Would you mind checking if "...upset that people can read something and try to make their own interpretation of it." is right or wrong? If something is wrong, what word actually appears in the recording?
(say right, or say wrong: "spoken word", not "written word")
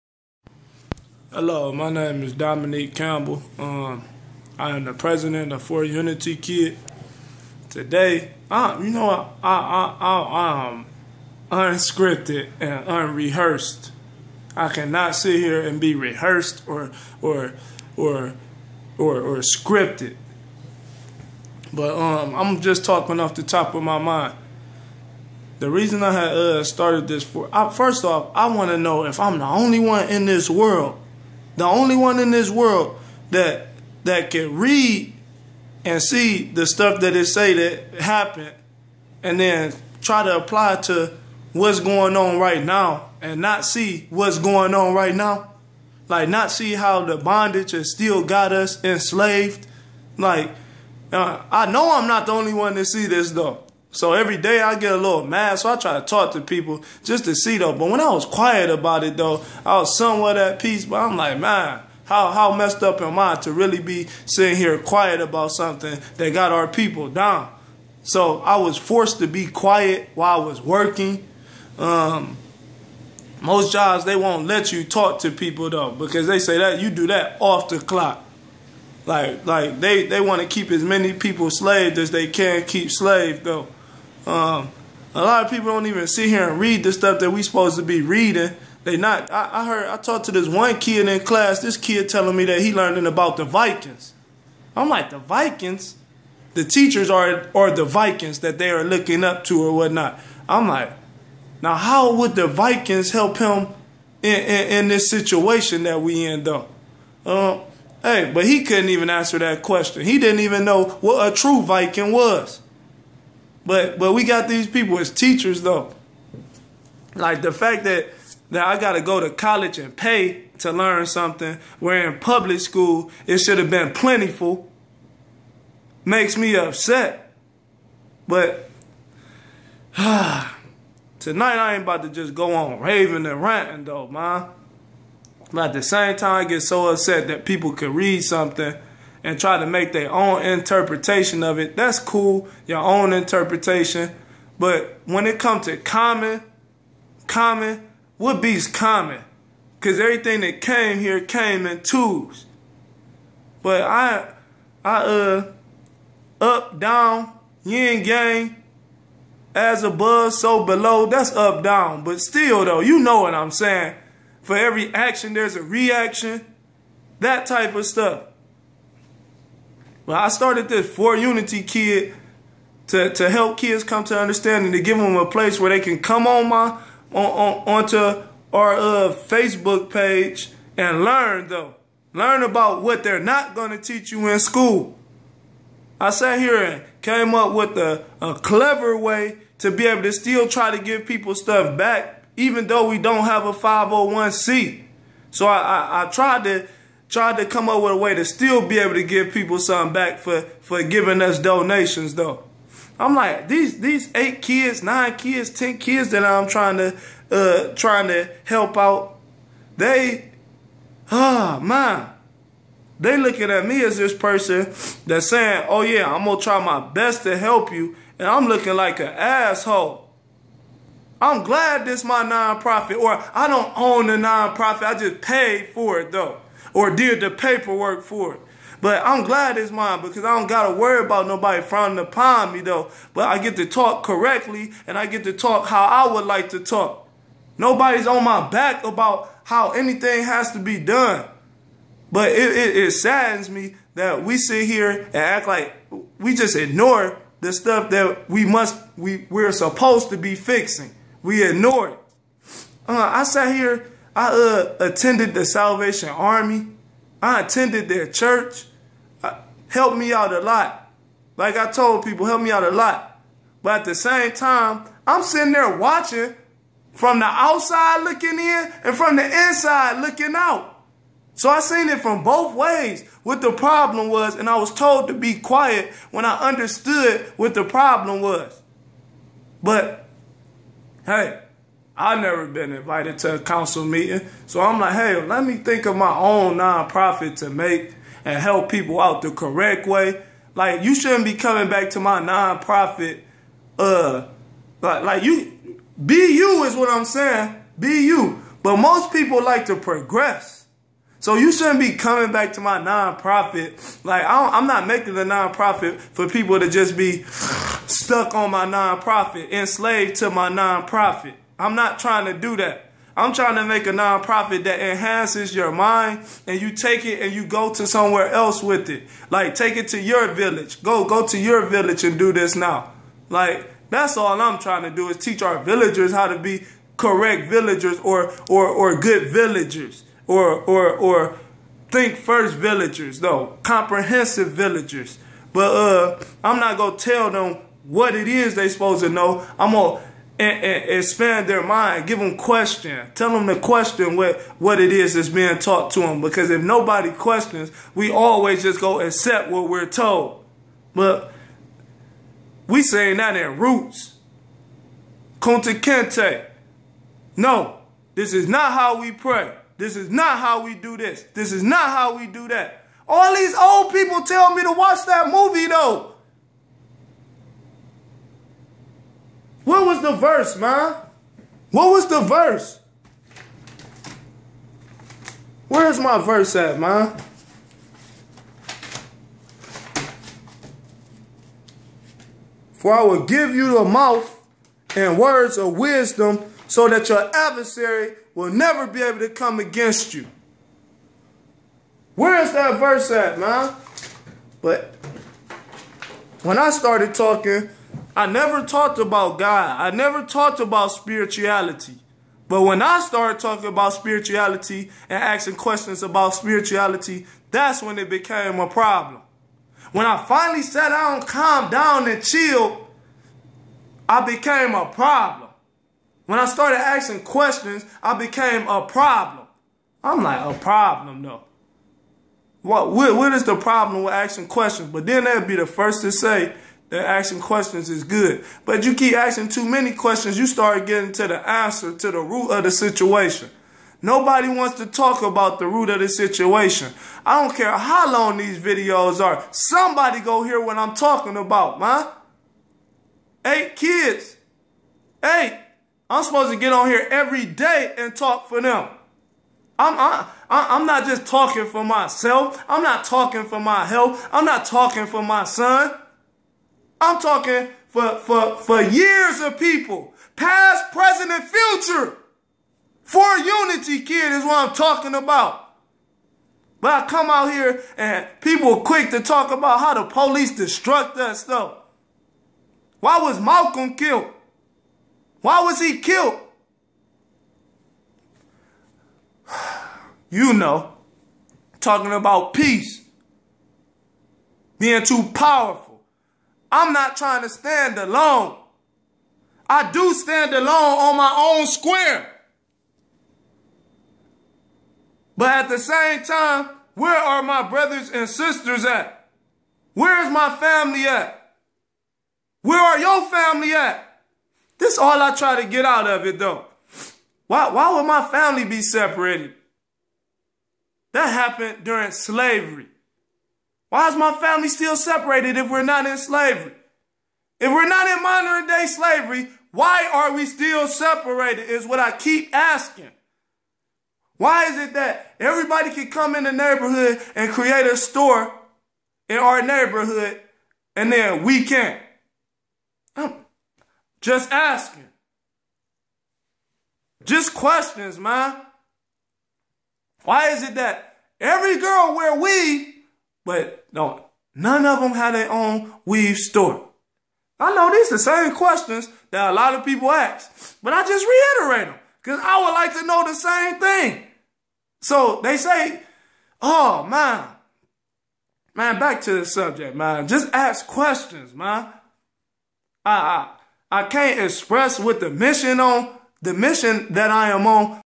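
right.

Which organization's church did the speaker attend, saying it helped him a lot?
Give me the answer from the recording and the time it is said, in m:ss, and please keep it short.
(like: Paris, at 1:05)
The Salvation Army, at 4:15.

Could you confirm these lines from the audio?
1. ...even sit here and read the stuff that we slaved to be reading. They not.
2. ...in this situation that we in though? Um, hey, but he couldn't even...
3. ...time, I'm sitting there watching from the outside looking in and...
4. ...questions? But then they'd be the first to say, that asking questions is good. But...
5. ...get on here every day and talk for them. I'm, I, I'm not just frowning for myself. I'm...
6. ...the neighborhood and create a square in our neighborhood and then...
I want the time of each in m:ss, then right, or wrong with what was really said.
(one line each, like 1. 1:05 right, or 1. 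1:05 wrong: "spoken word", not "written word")
1. 1:25 wrong: "supposed", not "slaved"
2. 1:44 right
3. 4:24 right
4. 7:04 right
5. 7:26 wrong: "talking", not "frowning"
6. 8:46 wrong: "store", not "square".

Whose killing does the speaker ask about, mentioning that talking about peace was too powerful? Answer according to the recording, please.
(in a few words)
Malcolm.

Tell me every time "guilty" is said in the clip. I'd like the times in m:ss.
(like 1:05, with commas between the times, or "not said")
not said.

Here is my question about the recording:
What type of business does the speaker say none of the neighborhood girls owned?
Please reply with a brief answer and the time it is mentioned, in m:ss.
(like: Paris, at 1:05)
Weave store, at 9:06.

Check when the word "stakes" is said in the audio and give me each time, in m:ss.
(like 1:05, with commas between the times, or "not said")
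not said.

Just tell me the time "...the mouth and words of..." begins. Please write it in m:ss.
6:23.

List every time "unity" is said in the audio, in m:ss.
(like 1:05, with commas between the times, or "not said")
0:05, 2:51, 7:43.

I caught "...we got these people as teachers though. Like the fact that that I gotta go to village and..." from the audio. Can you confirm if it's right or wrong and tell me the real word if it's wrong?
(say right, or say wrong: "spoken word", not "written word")
wrong: "college", not "village".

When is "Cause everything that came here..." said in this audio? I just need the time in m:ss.
2:29.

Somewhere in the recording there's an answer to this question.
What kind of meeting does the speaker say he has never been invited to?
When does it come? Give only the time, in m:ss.
4:43.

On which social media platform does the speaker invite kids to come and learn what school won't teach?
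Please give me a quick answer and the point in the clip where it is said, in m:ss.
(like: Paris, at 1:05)
Facebook, at 2:59.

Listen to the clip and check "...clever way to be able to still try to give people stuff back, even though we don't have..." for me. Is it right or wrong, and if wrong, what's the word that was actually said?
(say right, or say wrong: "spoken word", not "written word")
right.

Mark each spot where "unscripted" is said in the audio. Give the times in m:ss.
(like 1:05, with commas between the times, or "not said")
0:11.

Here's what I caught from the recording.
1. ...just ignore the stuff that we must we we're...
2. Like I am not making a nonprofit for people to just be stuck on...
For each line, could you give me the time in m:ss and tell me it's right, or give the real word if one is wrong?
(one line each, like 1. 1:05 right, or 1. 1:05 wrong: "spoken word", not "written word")
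1. 4:06 right
2. 5:04 right.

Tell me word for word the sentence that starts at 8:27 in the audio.
Why, why would my family be separated?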